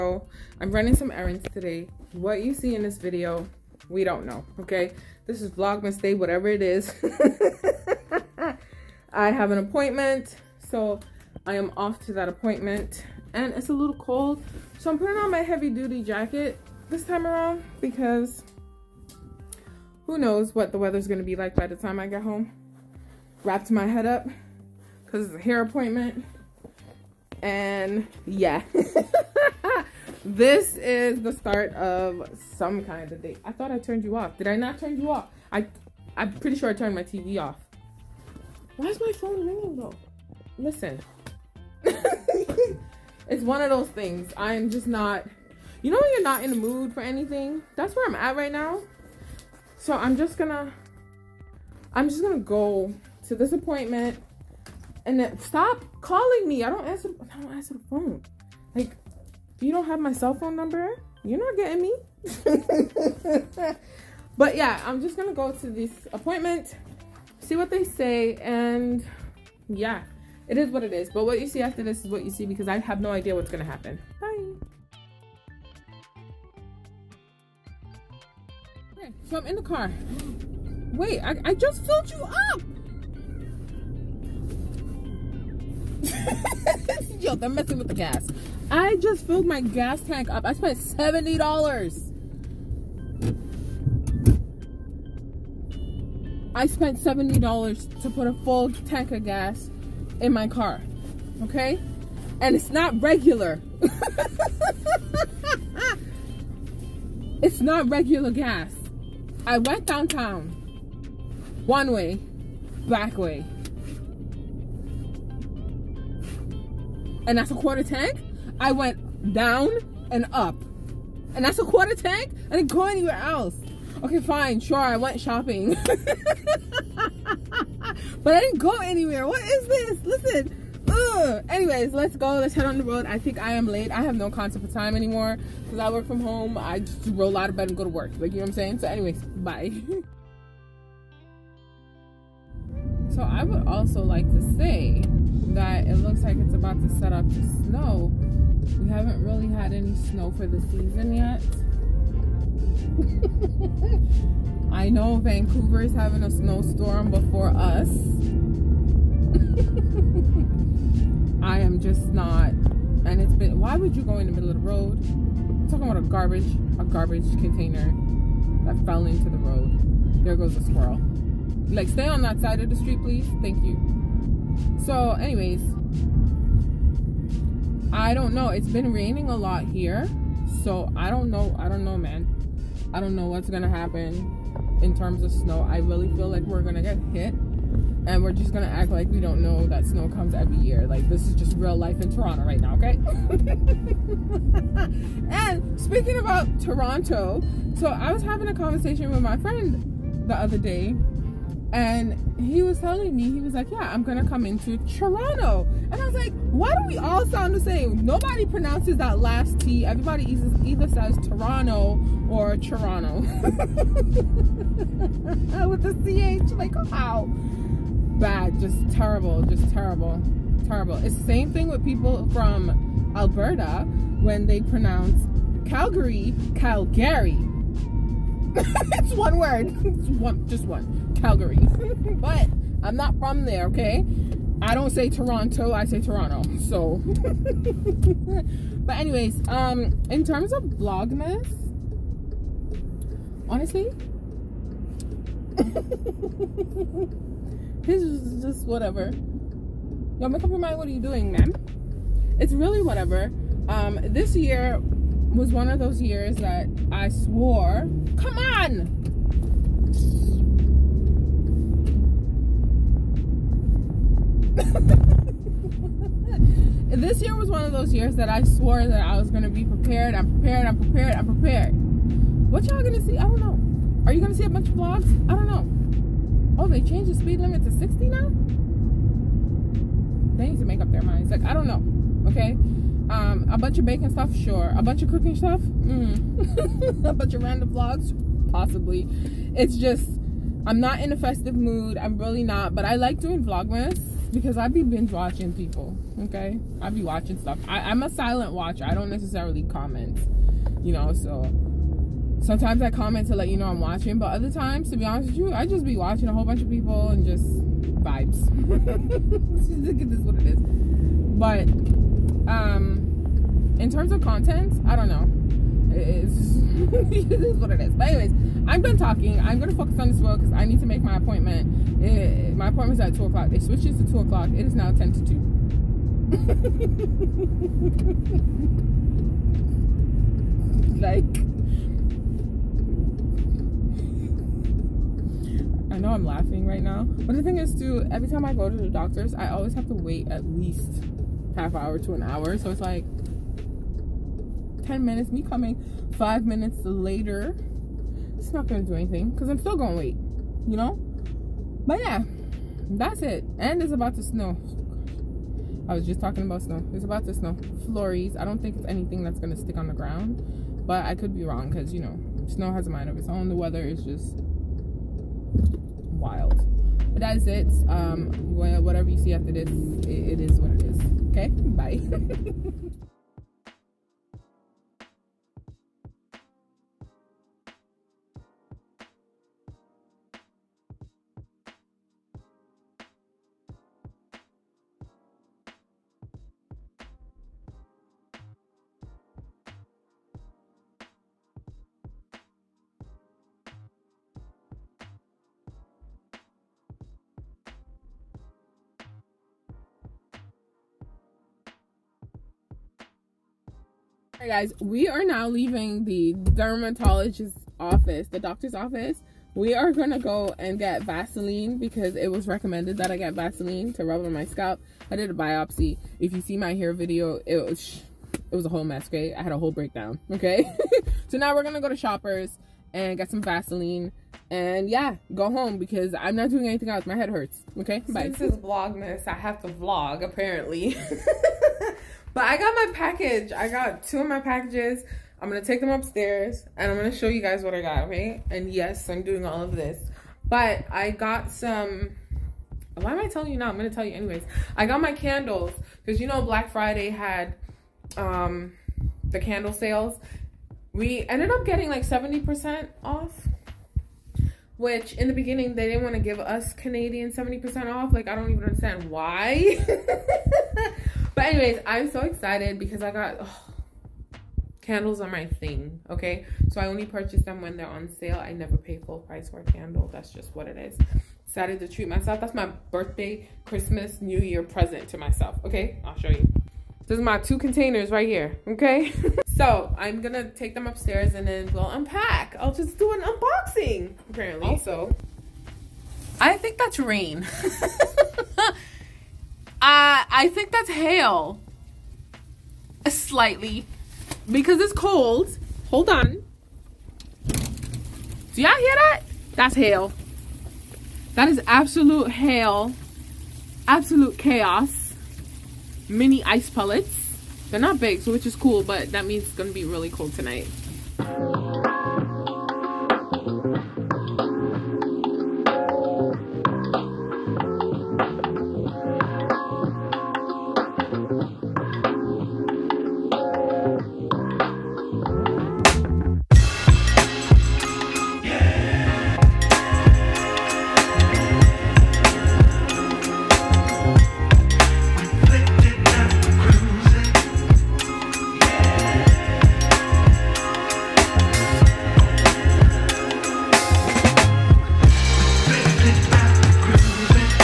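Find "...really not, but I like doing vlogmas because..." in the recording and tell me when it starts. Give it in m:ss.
4:52.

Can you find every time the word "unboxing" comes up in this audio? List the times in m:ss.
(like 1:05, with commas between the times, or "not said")
8:03.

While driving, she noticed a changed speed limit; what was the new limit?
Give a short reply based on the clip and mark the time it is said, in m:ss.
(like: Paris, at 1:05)
60, at 4:37.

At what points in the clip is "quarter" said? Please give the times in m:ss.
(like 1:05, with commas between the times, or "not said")
1:57, 2:01.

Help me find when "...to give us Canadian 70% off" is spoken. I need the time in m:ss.
7:36.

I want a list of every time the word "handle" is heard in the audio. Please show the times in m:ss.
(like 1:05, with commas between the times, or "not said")
not said.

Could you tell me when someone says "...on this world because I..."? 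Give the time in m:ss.
5:19.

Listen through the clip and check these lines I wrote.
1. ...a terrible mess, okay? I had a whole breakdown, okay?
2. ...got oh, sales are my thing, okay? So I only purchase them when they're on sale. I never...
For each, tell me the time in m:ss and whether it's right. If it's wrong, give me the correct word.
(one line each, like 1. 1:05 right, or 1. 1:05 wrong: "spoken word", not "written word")
1. 6:58 wrong: "whole", not "terrible"
2. 7:43 wrong: "candles", not "sales".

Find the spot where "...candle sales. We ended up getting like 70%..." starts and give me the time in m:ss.
7:29.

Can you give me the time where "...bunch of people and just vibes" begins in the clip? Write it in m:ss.
5:06.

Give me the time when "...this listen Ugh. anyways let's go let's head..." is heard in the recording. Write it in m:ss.
2:09.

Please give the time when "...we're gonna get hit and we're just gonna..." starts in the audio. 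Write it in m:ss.
3:06.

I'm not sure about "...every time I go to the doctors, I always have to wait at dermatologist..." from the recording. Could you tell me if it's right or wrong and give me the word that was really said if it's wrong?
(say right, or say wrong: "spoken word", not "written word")
wrong: "least", not "dermatologist".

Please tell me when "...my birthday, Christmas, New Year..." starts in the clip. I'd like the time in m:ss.
7:52.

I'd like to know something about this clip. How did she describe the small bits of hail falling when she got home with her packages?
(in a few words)
mini ice pellets.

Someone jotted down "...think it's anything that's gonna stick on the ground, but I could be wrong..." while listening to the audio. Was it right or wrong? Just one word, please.
right.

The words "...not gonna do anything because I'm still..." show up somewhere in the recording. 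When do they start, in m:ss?
5:48.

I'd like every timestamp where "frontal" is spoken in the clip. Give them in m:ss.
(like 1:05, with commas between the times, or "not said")
not said.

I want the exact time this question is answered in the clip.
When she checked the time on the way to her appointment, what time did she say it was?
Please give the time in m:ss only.
5:24.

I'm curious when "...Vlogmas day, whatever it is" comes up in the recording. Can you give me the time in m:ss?
0:05.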